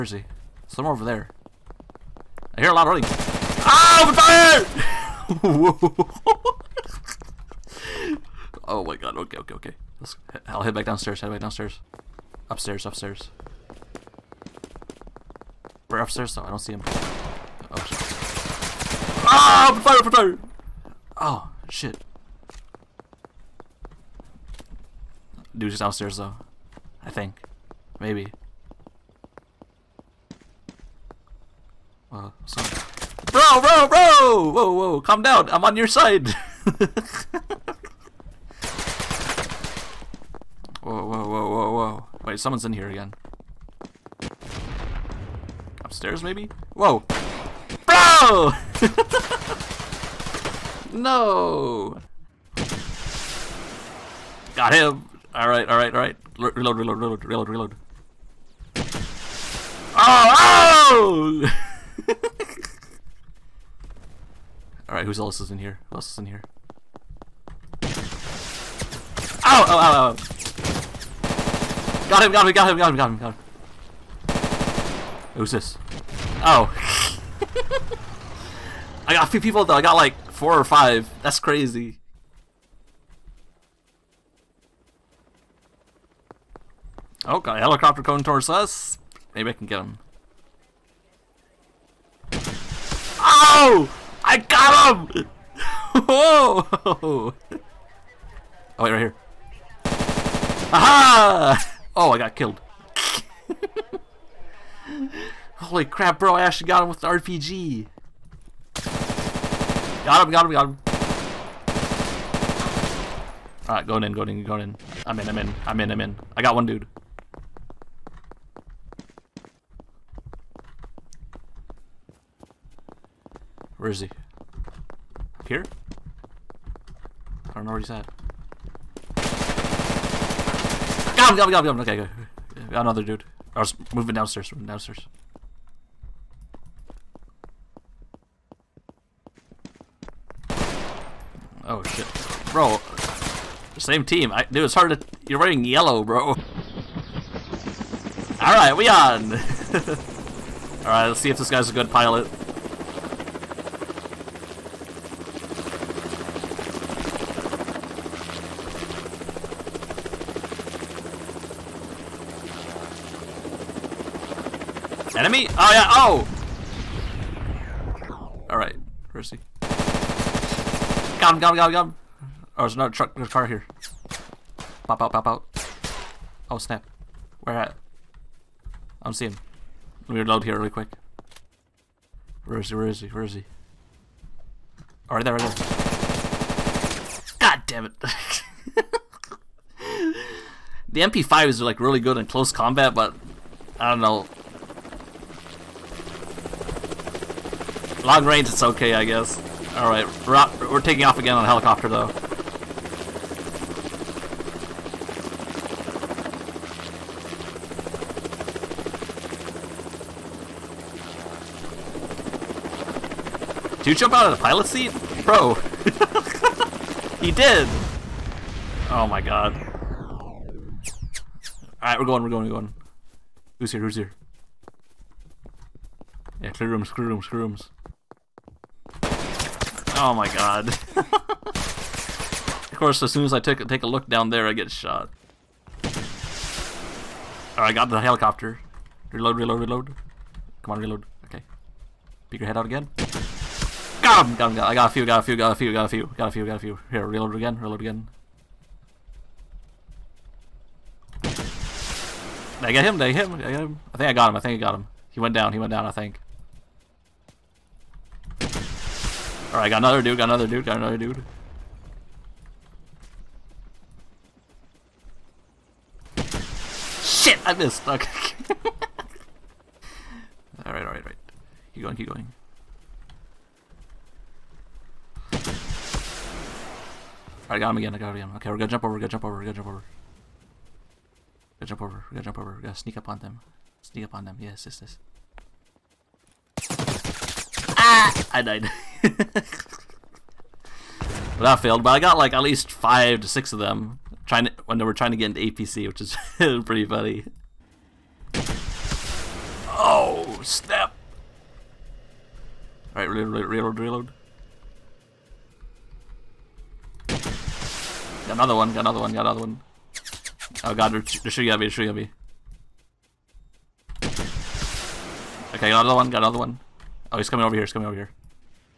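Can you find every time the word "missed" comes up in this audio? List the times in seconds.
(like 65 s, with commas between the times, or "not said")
267 s.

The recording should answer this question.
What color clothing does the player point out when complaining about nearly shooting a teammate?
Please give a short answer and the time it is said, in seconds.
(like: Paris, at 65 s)
yellow, at 145 s.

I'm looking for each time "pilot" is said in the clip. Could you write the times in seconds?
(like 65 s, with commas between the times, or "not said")
151 s, 214 s.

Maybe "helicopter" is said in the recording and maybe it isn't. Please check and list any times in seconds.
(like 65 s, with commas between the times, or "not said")
87 s, 201 s, 238 s.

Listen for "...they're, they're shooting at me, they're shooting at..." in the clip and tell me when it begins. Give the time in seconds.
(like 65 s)
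310 s.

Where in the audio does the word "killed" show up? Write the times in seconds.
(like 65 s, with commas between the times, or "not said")
102 s.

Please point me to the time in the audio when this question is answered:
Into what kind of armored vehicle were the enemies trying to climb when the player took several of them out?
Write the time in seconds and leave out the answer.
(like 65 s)
295 s.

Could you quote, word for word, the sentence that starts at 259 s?
Alright, got another dude, got another dude, got another dude.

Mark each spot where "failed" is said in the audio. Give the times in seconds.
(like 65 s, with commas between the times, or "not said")
291 s.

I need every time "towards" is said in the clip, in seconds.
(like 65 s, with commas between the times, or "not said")
88 s.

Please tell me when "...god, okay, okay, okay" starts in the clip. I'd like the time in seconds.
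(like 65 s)
8 s.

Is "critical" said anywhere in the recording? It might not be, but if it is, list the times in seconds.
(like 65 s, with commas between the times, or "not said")
not said.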